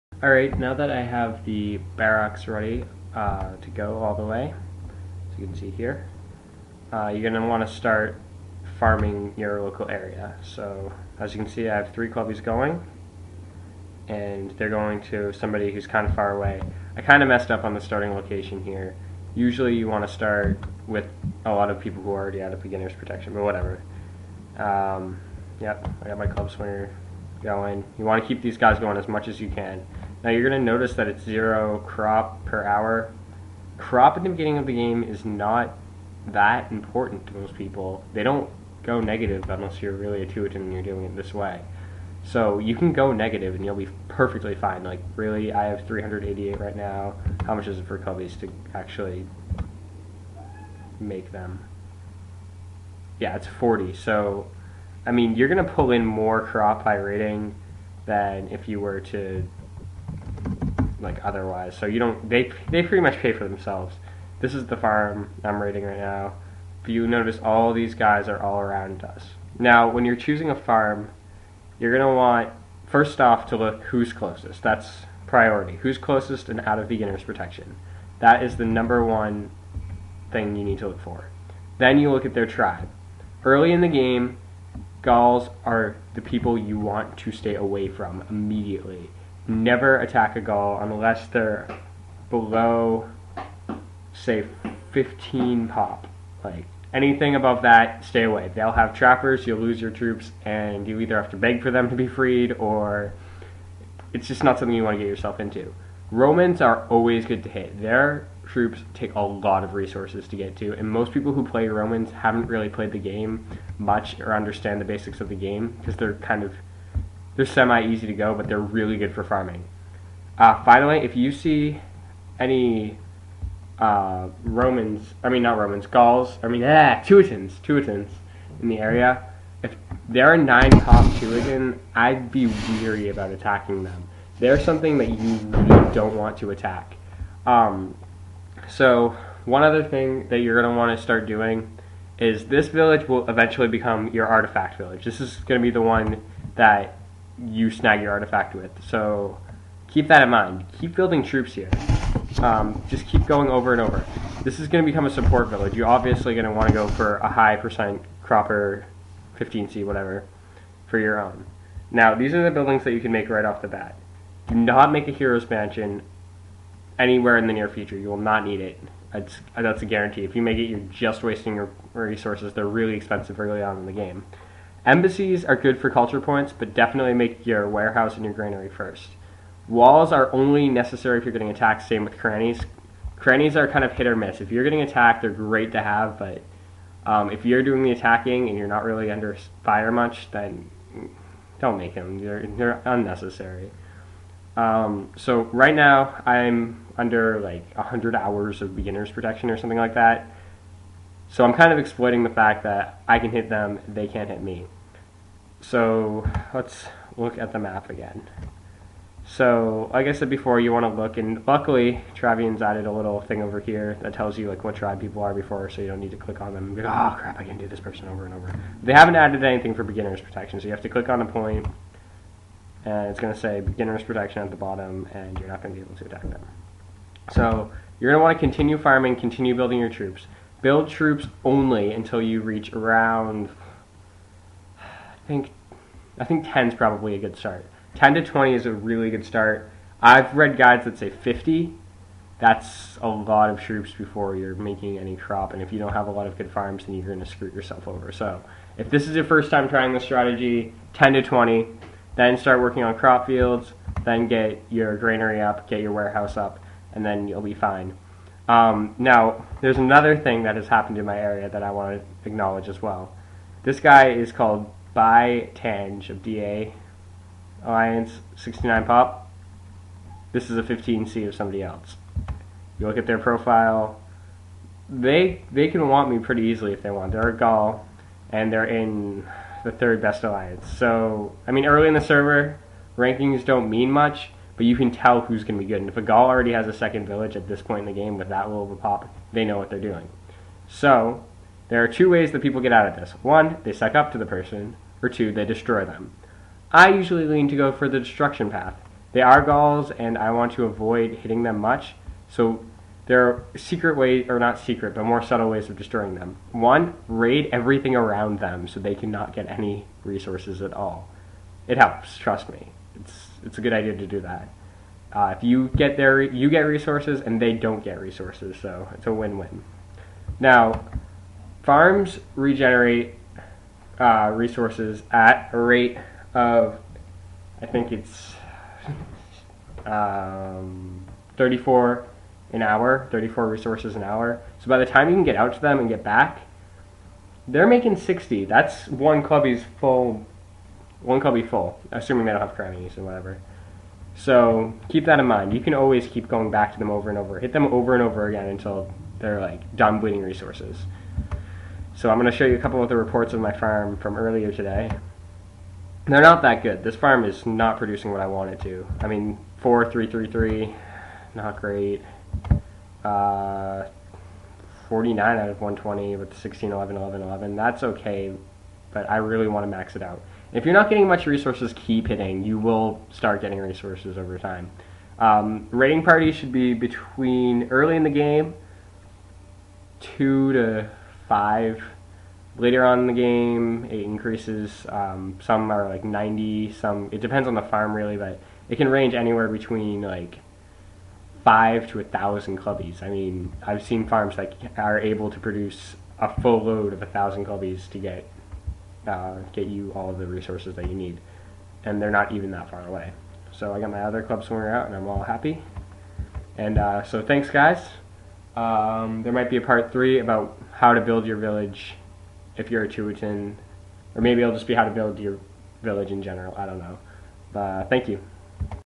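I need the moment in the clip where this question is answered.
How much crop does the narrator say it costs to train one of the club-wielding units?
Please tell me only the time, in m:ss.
0:53.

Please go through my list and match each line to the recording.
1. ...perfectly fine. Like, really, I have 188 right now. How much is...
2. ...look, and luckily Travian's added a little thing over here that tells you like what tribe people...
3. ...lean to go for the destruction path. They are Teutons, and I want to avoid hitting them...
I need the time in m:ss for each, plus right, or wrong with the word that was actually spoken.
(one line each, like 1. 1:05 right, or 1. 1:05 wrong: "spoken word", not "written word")
1. 0:44 wrong: "388", not "188"
2. 3:31 right
3. 4:57 wrong: "Gauls", not "Teutons".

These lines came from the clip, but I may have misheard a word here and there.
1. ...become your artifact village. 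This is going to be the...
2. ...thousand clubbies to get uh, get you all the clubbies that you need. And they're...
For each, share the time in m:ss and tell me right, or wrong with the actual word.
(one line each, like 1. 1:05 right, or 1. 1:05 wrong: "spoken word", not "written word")
1. 2:23 right
2. 6:37 wrong: "resources", not "clubbies".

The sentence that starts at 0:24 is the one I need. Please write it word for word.
Um, yep, I got my club swinger going.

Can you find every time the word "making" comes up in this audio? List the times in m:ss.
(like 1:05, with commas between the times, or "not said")
4:04, 5:37.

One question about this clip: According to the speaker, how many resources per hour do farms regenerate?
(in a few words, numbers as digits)
34.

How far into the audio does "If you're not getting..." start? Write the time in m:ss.
6:10.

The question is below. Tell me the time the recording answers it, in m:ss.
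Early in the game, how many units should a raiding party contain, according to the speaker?
6:19.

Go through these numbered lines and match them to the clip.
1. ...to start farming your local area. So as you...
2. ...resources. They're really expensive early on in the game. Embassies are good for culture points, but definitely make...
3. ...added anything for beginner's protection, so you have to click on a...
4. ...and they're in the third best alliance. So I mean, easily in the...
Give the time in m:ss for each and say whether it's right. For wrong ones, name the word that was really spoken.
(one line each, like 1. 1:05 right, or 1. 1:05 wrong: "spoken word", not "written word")
1. 0:07 right
2. 2:51 right
3. 3:39 right
4. 4:38 wrong: "early", not "easily".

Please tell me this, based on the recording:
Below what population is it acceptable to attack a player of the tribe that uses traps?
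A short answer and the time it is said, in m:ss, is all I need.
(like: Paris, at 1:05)
15, at 1:34.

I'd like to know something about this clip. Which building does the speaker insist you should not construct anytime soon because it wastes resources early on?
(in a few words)
Hero's mansion.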